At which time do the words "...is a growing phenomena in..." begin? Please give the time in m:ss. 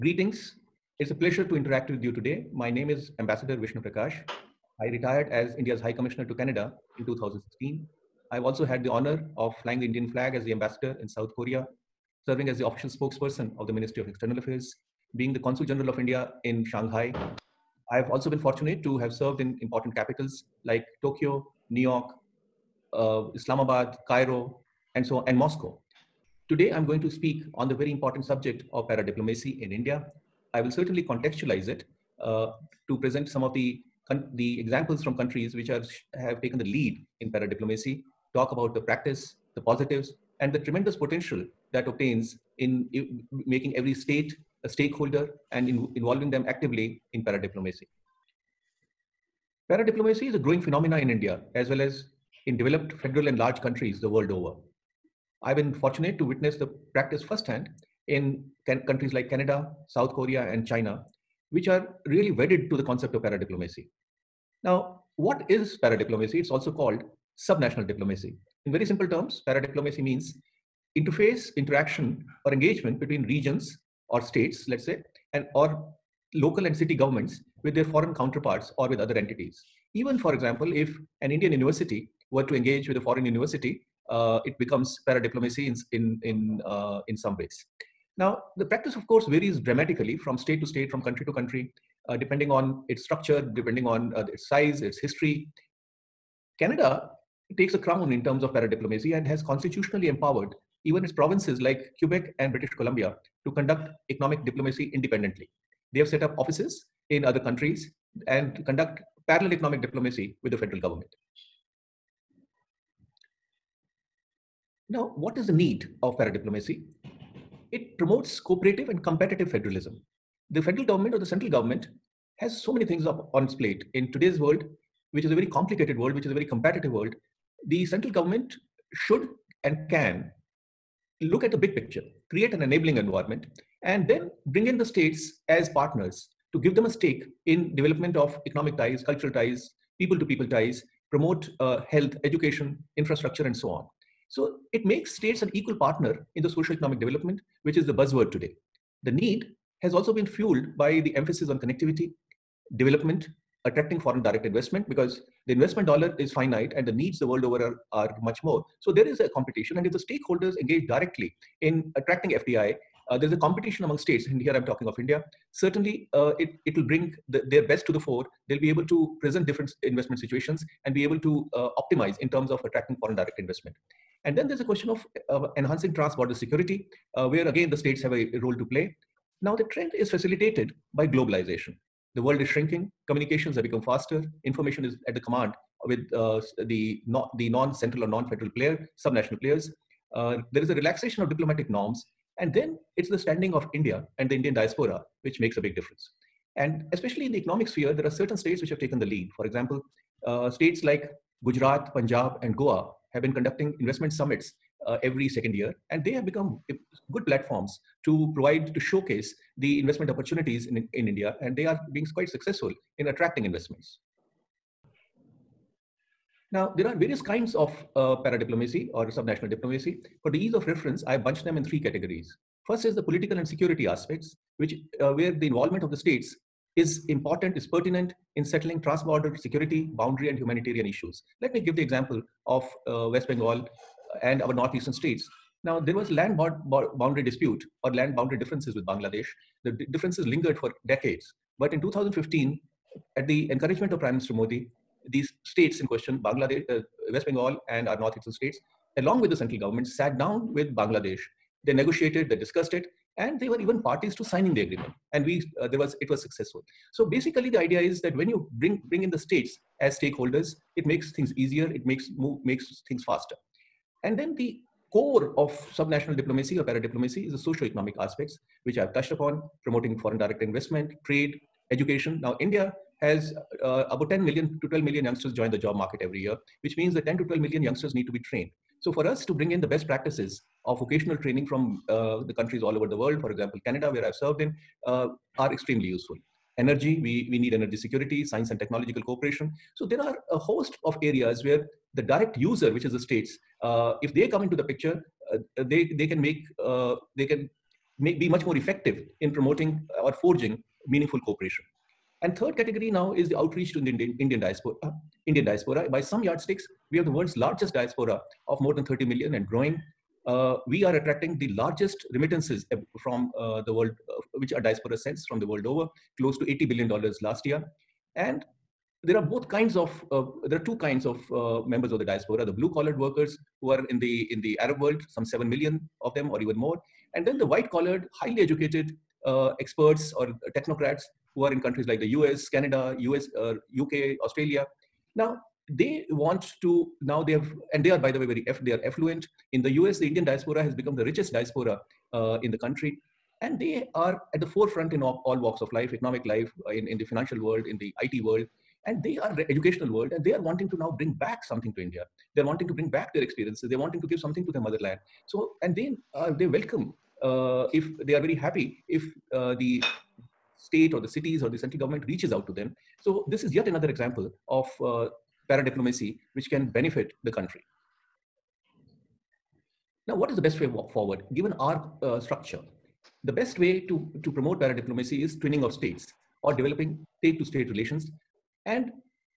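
0:50.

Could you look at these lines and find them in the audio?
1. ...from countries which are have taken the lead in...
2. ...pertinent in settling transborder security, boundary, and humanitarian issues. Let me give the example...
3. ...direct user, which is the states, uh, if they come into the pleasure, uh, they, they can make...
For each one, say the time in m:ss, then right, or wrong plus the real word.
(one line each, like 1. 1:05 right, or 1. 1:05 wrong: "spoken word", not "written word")
1. 0:35 right
2. 3:47 right
3. 4:52 wrong: "picture", not "pleasure".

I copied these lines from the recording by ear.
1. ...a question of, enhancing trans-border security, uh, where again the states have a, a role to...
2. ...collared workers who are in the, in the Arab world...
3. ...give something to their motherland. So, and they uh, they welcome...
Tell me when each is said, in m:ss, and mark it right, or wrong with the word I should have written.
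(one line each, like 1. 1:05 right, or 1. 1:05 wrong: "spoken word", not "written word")
1. 2:54 right
2. 5:22 right
3. 5:54 right.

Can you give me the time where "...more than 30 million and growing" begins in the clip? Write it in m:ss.
5:08.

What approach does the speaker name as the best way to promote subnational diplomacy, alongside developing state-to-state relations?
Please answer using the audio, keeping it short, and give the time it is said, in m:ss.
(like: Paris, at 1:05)
twinning of states, at 6:15.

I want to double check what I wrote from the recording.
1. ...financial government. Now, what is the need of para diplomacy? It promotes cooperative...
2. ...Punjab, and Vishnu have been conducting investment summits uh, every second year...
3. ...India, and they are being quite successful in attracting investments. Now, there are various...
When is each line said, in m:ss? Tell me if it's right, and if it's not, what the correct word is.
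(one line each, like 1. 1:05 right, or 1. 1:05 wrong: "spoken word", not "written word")
1. 1:50 wrong: "federal", not "financial"
2. 3:21 wrong: "Goa", not "Vishnu"
3. 3:31 right.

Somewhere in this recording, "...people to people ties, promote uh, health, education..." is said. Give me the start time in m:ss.
2:20.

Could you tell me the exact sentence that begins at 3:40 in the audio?
For the ease of reference, I bunched them in three categories.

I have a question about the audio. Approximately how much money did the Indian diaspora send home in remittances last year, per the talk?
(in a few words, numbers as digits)
$80 billion.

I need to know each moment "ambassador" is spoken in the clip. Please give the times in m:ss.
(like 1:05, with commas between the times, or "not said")
0:03, 0:10.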